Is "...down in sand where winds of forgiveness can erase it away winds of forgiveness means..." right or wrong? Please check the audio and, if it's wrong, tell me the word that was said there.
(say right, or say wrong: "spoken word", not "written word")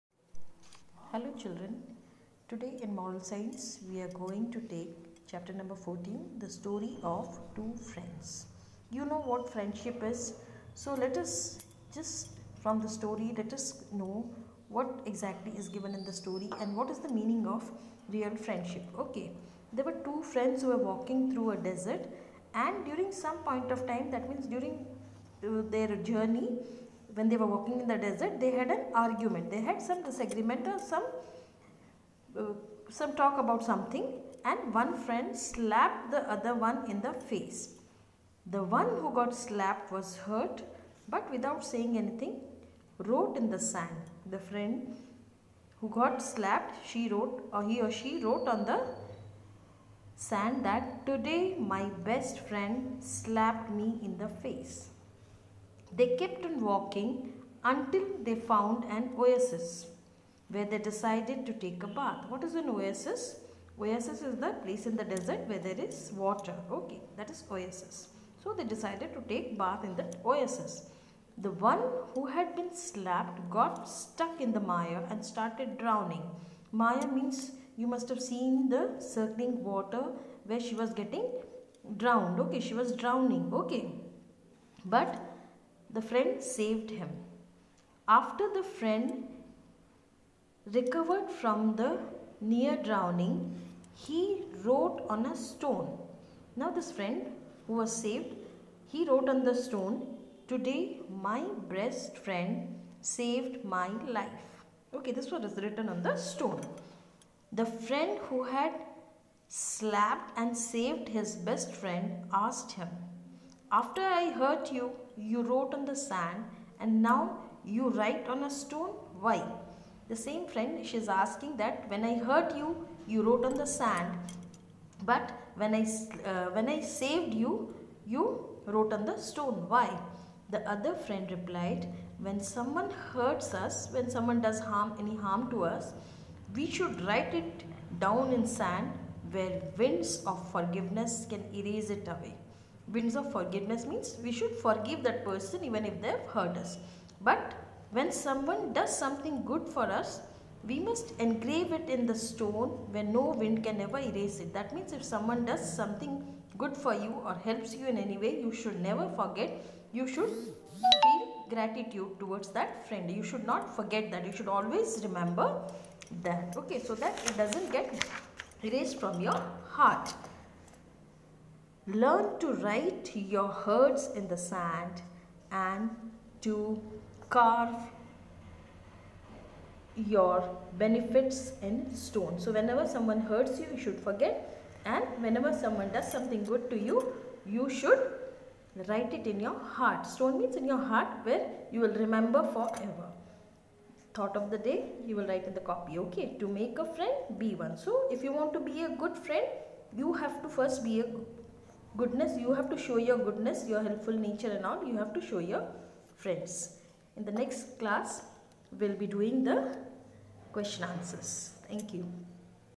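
right.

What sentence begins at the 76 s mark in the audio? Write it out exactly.
Maya means you must have seen the circling water where she was getting drowned.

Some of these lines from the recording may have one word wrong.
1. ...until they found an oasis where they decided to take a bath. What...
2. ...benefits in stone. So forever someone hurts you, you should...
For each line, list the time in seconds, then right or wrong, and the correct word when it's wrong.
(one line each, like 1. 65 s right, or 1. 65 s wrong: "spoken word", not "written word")
1. 57 s right
2. 180 s wrong: "whenever", not "forever".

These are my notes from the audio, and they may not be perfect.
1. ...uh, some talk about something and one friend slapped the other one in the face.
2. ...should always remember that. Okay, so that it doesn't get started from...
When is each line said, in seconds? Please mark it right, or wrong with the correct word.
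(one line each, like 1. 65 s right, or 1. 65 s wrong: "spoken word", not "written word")
1. 32 s right
2. 164 s wrong: "erased", not "started".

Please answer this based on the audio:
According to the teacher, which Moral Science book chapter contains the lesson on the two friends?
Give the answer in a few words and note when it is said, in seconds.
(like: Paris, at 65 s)
14, at 5 s.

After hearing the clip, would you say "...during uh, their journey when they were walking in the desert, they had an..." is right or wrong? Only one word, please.
right.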